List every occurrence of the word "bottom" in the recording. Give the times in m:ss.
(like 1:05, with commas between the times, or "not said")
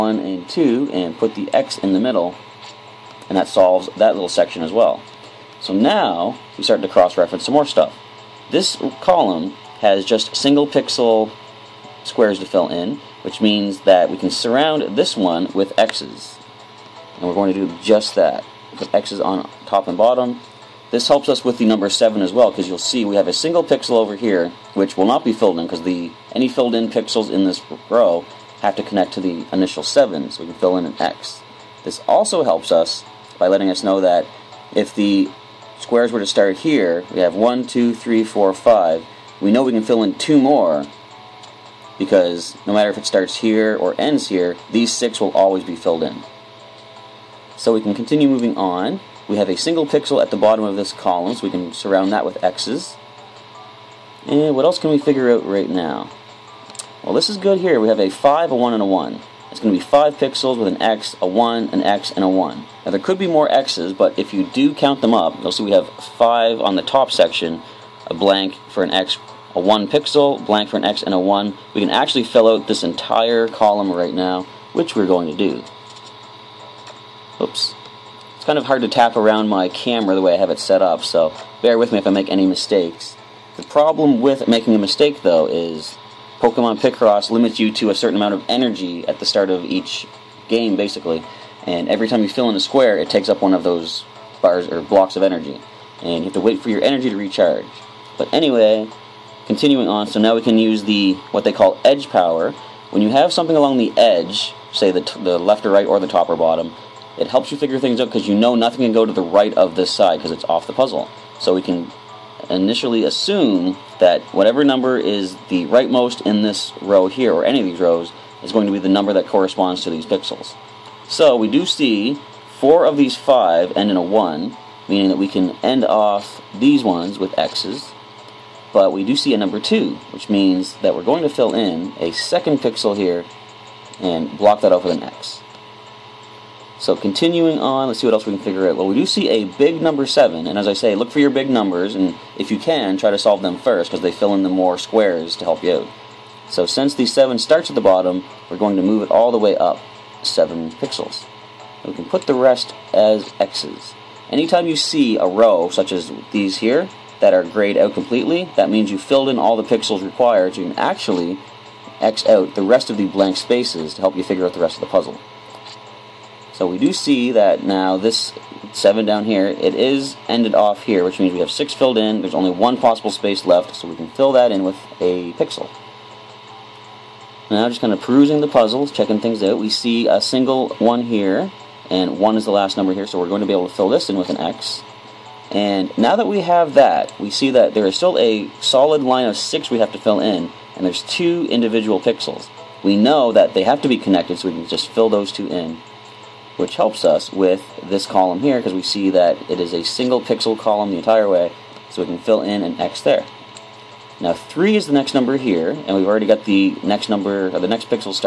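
0:19, 0:50, 1:46, 2:27.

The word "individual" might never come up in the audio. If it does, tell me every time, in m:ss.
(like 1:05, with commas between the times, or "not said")
3:11.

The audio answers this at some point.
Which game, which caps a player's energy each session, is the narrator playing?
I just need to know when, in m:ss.
1:26.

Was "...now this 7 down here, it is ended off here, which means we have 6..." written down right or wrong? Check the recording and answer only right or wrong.
right.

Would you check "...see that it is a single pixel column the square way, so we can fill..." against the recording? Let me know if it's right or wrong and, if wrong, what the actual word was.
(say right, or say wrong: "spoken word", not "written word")
wrong: "entire", not "square".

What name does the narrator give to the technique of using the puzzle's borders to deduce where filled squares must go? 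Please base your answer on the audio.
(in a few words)
edge power.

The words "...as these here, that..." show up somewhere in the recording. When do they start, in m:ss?
2:35.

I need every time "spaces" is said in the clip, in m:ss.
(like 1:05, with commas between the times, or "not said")
2:43, 2:53.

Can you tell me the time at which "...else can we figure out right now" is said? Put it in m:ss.
0:54.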